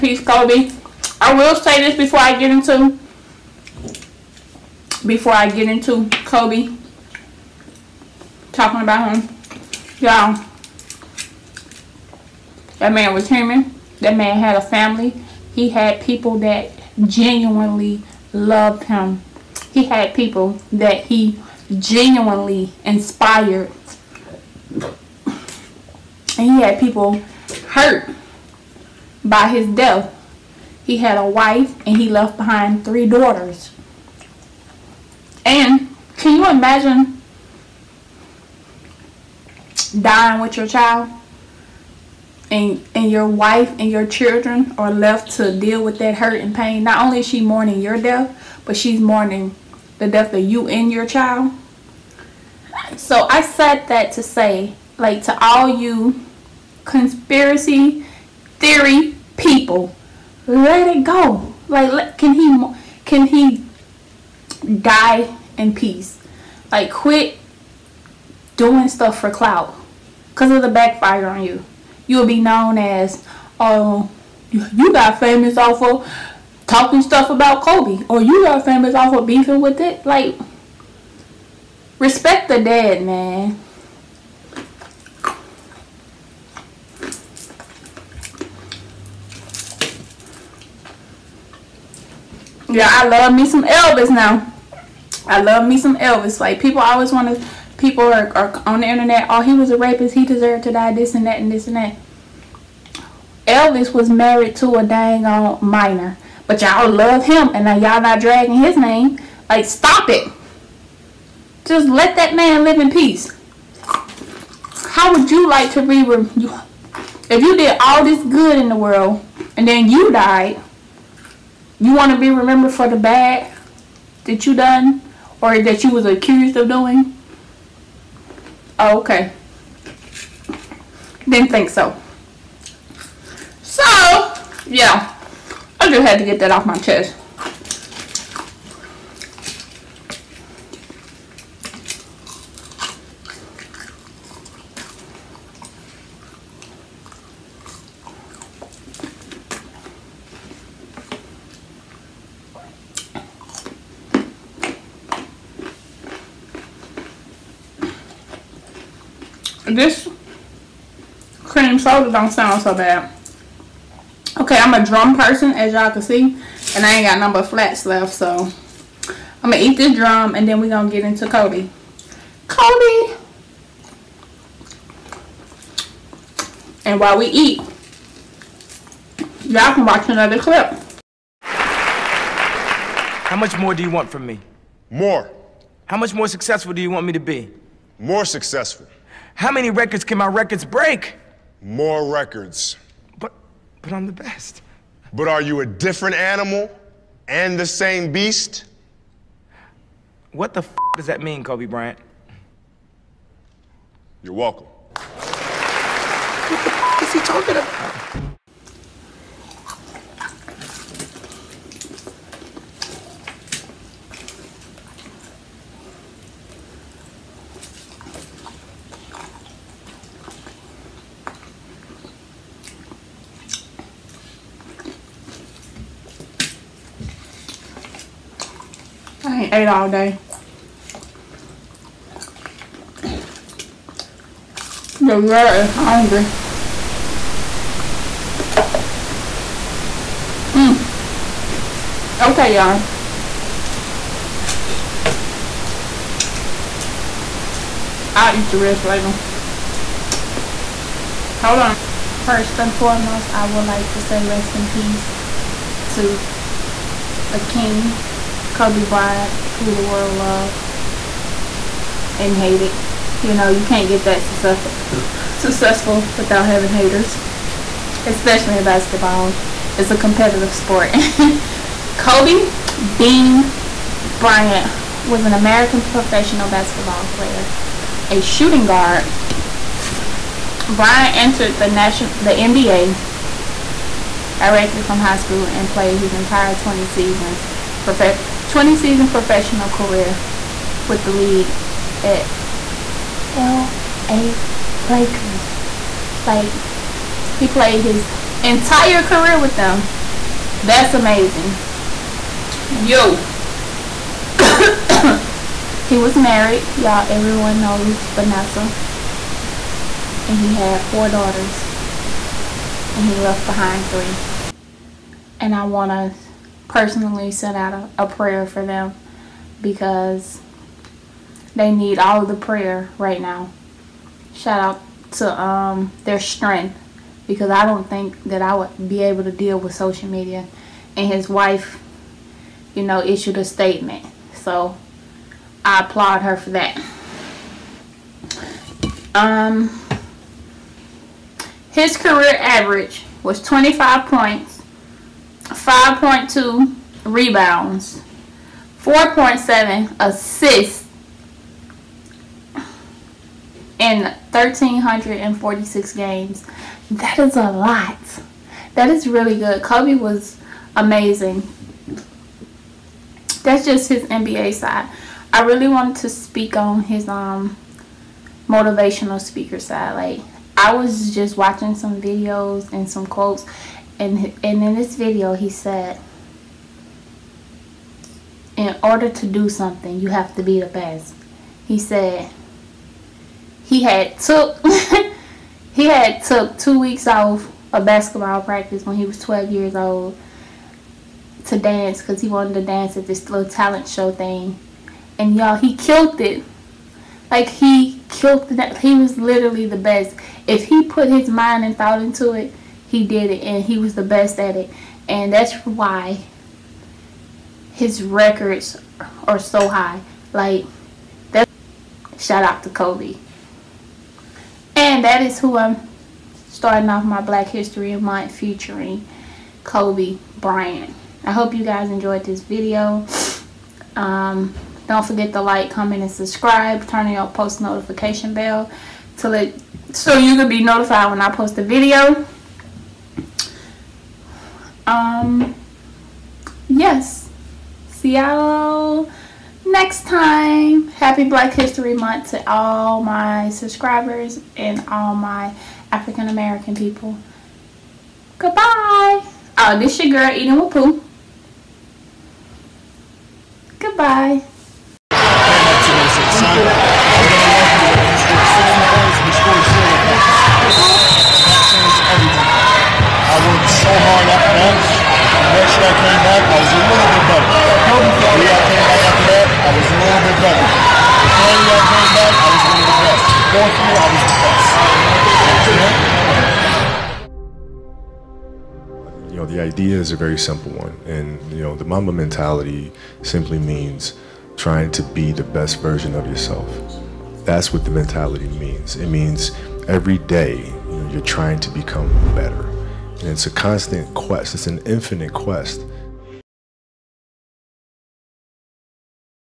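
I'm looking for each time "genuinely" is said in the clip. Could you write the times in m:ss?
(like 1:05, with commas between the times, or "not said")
0:17, 0:21.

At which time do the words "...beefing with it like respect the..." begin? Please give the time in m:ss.
1:19.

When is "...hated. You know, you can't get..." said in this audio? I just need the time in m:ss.
4:22.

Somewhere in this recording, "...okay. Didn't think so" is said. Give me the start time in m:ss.
2:08.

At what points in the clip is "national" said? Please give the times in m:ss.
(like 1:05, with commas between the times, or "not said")
4:41.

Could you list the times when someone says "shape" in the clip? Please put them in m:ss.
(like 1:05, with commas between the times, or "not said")
not said.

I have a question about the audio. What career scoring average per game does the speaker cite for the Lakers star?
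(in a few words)
25 points.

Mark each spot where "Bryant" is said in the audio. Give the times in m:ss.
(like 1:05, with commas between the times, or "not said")
3:21, 4:18, 4:34, 4:40, 7:00.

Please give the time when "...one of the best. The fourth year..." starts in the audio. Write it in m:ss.
7:53.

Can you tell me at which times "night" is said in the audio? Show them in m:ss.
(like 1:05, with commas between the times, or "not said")
not said.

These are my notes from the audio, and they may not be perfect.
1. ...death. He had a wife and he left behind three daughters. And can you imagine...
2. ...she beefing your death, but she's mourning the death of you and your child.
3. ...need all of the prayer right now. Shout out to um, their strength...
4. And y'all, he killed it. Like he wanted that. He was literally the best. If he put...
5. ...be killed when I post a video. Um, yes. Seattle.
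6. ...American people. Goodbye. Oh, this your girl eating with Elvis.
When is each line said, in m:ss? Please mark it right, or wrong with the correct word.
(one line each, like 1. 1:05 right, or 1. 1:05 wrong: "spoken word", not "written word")
1. 0:29 right
2. 0:47 wrong: "mourning", not "beefing"
3. 5:21 right
4. 6:35 wrong: "killed", not "wanted"
5. 7:10 wrong: "notified", not "killed"
6. 7:26 wrong: "Pooh", not "Elvis".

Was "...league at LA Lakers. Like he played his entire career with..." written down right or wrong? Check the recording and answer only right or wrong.
right.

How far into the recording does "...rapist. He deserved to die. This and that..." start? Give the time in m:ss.
1:39.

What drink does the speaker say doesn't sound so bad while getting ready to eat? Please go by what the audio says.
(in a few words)
Cream soda.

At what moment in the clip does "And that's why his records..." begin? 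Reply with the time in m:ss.
6:45.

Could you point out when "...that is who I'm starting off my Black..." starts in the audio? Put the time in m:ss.
6:55.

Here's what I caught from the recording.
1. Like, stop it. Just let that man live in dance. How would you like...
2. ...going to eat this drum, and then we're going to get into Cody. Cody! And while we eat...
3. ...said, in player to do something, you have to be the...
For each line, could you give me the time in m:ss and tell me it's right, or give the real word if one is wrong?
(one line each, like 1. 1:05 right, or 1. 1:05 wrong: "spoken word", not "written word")
1. 1:49 wrong: "peace", not "dance"
2. 2:49 right
3. 6:15 wrong: "order", not "player".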